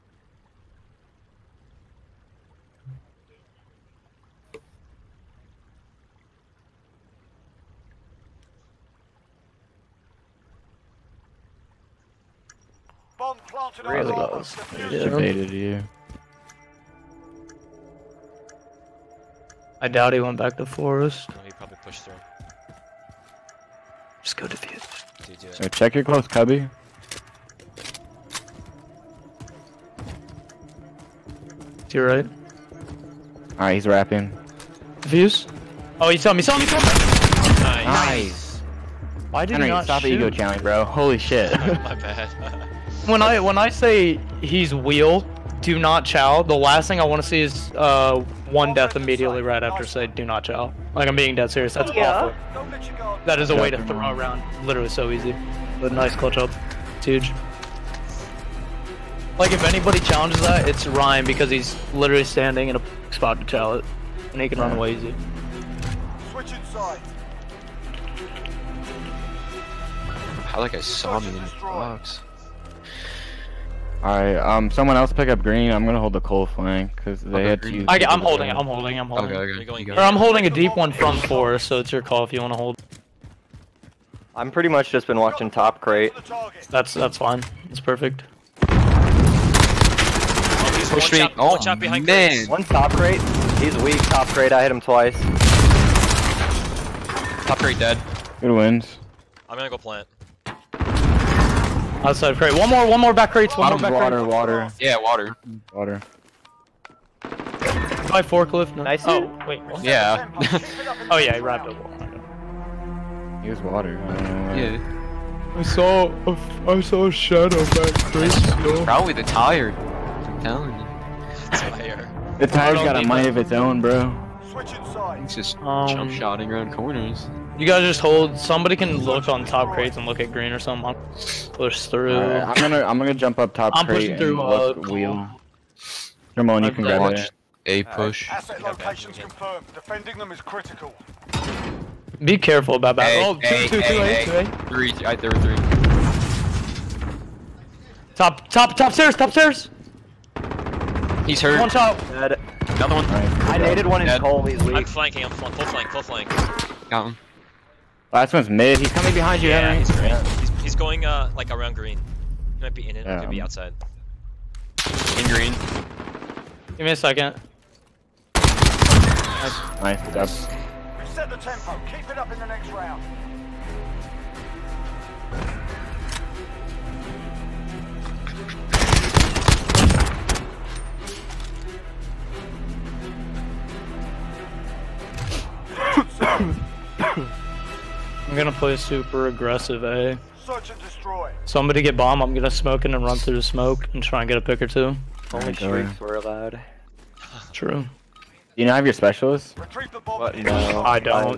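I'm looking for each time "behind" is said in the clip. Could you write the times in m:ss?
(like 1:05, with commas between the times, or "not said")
1:31, 2:39.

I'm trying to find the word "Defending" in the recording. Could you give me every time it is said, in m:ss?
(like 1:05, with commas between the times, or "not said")
2:19.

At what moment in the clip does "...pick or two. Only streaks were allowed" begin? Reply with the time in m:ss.
3:14.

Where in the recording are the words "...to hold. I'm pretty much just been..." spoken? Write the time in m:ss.
1:22.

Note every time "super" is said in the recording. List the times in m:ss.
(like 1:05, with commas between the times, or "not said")
3:08.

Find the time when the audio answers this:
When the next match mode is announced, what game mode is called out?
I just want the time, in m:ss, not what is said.
3:10.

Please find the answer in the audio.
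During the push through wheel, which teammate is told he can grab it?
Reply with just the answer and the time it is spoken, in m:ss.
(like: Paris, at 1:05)
Ramon, at 2:16.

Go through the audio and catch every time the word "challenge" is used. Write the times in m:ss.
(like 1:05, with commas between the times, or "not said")
0:40, 0:59.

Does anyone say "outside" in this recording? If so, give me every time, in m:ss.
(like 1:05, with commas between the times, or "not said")
1:42, 2:43.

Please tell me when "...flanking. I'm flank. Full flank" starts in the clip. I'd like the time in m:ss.
2:34.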